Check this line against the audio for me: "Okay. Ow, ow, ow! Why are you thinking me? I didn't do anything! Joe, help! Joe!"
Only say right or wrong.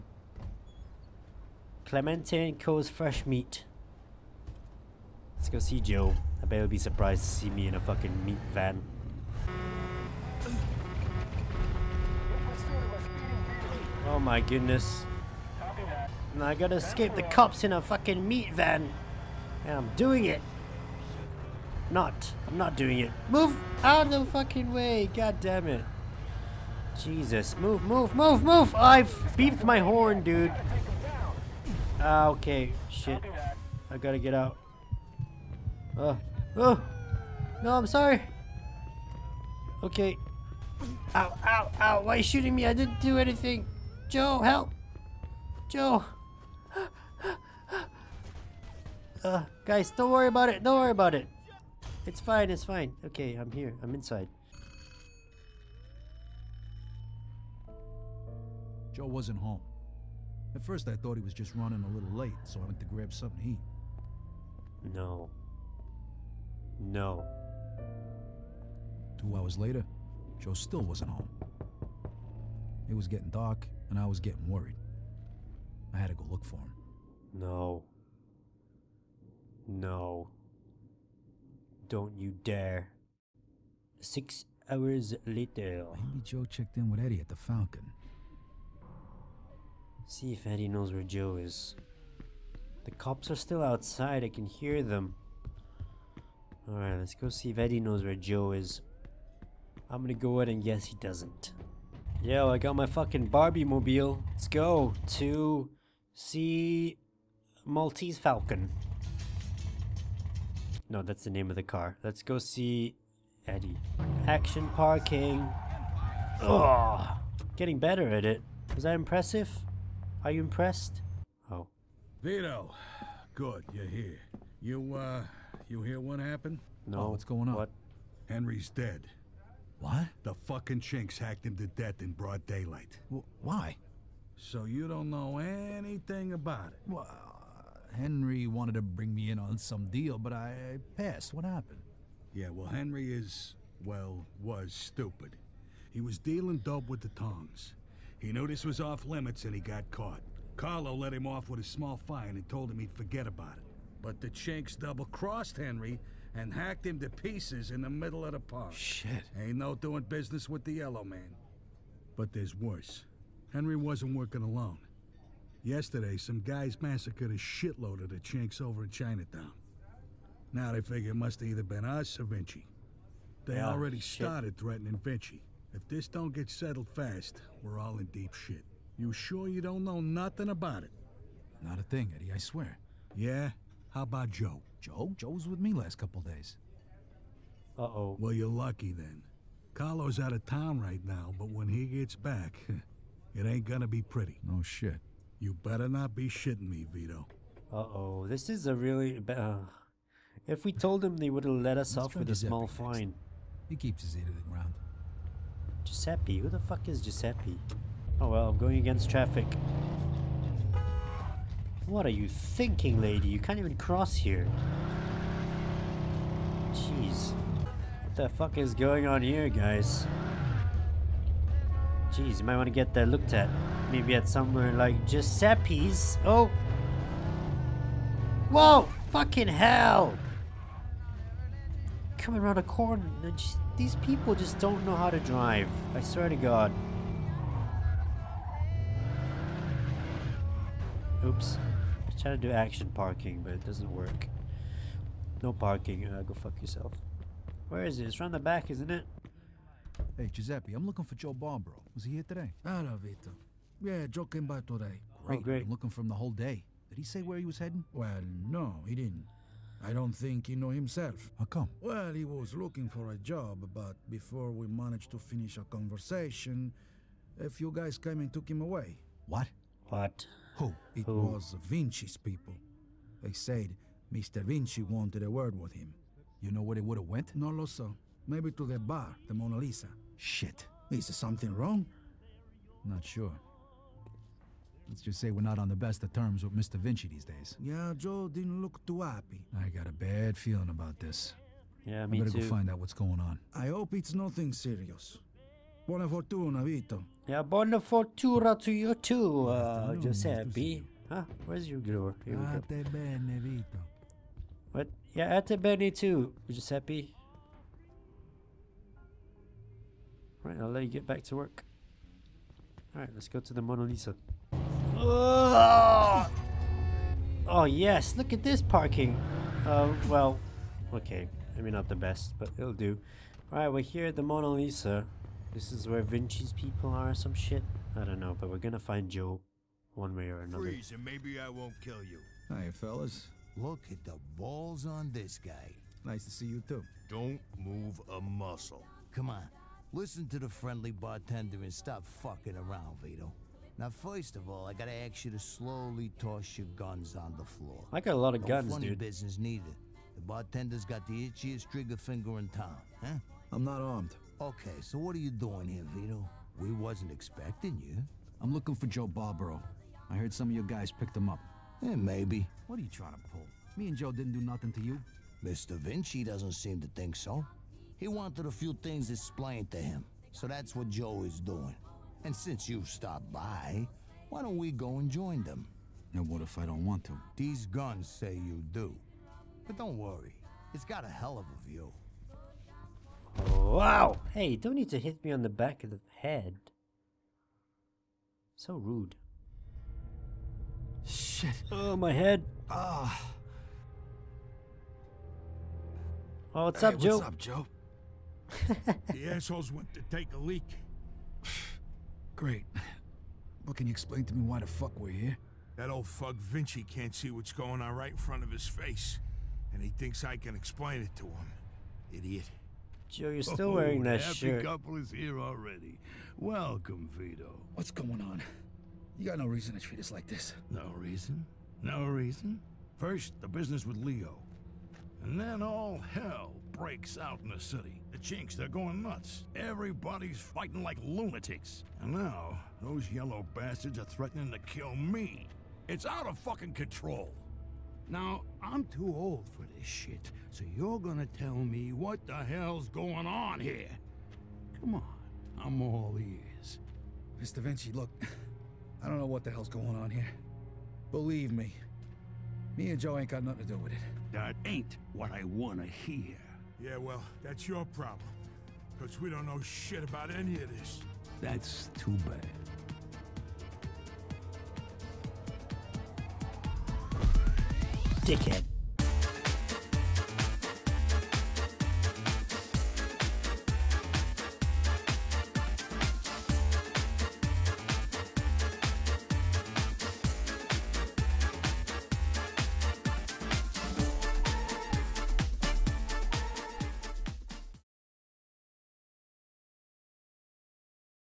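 wrong.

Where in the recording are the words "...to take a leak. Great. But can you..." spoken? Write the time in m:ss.
6:39.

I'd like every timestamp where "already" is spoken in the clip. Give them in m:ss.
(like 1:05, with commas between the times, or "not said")
2:53, 6:55.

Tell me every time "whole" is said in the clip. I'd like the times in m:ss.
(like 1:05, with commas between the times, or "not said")
4:16.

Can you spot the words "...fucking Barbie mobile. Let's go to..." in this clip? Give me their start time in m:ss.
1:42.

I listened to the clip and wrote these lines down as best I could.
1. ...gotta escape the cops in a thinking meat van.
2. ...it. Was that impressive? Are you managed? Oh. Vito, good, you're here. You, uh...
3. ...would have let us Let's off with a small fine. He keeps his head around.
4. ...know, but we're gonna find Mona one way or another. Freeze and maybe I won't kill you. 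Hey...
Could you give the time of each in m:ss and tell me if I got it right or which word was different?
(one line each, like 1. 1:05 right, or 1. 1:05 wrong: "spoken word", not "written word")
1. 0:16 wrong: "fucking", not "thinking"
2. 1:58 wrong: "impressed", not "managed"
3. 3:21 right
4. 5:28 wrong: "Joe", not "Mona".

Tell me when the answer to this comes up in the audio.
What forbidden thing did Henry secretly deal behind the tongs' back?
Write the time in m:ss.
2:26.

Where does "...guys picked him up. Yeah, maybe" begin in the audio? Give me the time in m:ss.
6:00.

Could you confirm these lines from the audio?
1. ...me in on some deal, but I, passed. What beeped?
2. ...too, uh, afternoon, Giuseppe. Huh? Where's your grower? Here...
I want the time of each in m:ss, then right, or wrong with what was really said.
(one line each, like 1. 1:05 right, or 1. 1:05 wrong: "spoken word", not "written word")
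1. 2:19 wrong: "happened", not "beeped"
2. 4:58 right.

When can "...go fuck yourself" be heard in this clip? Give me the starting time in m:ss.
4:06.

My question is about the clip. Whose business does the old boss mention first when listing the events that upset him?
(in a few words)
Leo.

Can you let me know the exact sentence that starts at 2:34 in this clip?
But the chinks double-crossed Henry and hacked him to pieces in the middle of the park.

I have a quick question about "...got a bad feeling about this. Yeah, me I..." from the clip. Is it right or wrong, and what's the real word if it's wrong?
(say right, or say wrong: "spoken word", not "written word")
right.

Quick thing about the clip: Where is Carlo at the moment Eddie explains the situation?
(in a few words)
Out of town.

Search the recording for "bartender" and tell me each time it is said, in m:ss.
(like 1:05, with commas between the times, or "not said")
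5:40, 5:50.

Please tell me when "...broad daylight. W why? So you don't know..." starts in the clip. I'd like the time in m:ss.
2:12.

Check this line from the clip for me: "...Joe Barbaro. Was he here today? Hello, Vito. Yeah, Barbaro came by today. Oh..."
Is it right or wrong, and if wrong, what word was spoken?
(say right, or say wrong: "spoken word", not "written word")
wrong: "Joe", not "Barbaro".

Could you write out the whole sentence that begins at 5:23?
Alright, we're here at the Mona Lisa.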